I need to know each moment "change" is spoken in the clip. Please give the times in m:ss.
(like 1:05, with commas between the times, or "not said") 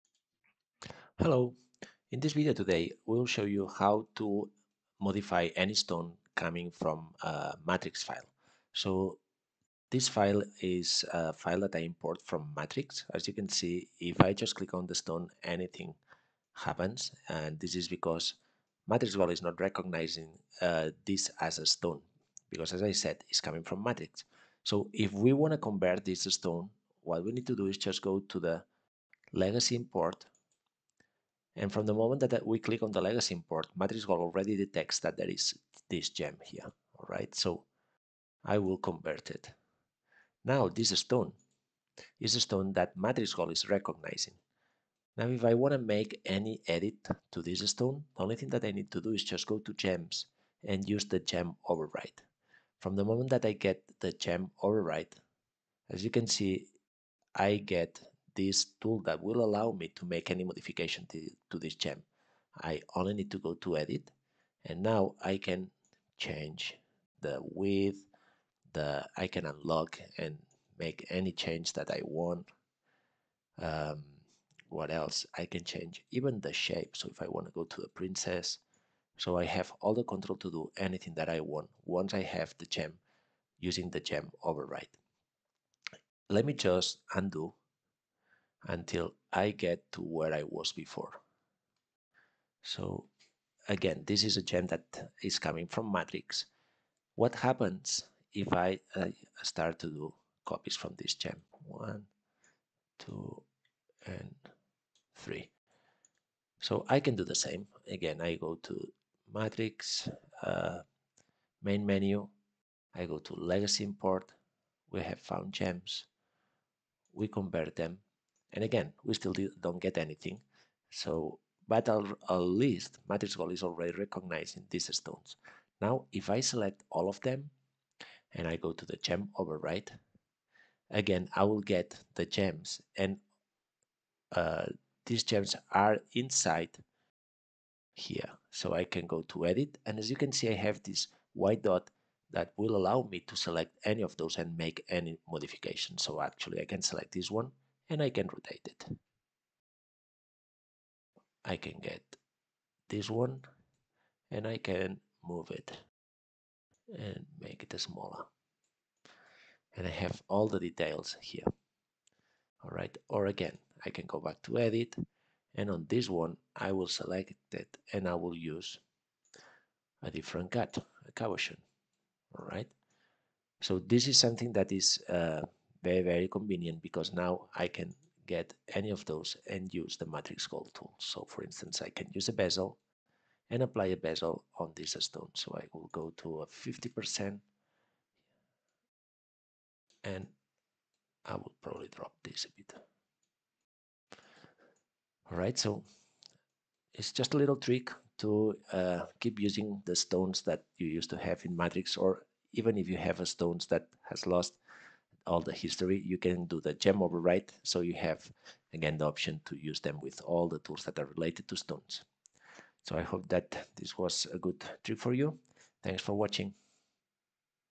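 1:06, 1:11, 1:15.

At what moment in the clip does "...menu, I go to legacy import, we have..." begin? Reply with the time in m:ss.
1:51.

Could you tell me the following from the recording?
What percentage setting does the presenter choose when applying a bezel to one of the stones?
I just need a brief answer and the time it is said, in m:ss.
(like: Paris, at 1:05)
50%, at 3:06.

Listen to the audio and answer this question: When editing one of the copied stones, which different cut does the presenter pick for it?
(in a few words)
Cushion.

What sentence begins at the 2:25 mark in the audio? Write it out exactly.
So actually I can select this one and I can rotate it.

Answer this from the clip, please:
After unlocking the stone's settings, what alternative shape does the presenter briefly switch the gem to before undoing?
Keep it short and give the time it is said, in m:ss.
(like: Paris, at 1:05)
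Princess, at 1:17.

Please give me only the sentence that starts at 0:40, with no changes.
Now this stone is a stone that Matrix Gold is recognizing.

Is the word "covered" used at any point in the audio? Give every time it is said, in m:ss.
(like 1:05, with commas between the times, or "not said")
not said.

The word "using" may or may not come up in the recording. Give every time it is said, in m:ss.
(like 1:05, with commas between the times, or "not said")
1:23, 3:19.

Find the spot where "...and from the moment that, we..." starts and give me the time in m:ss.
0:31.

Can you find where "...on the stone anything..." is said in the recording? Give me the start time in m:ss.
0:14.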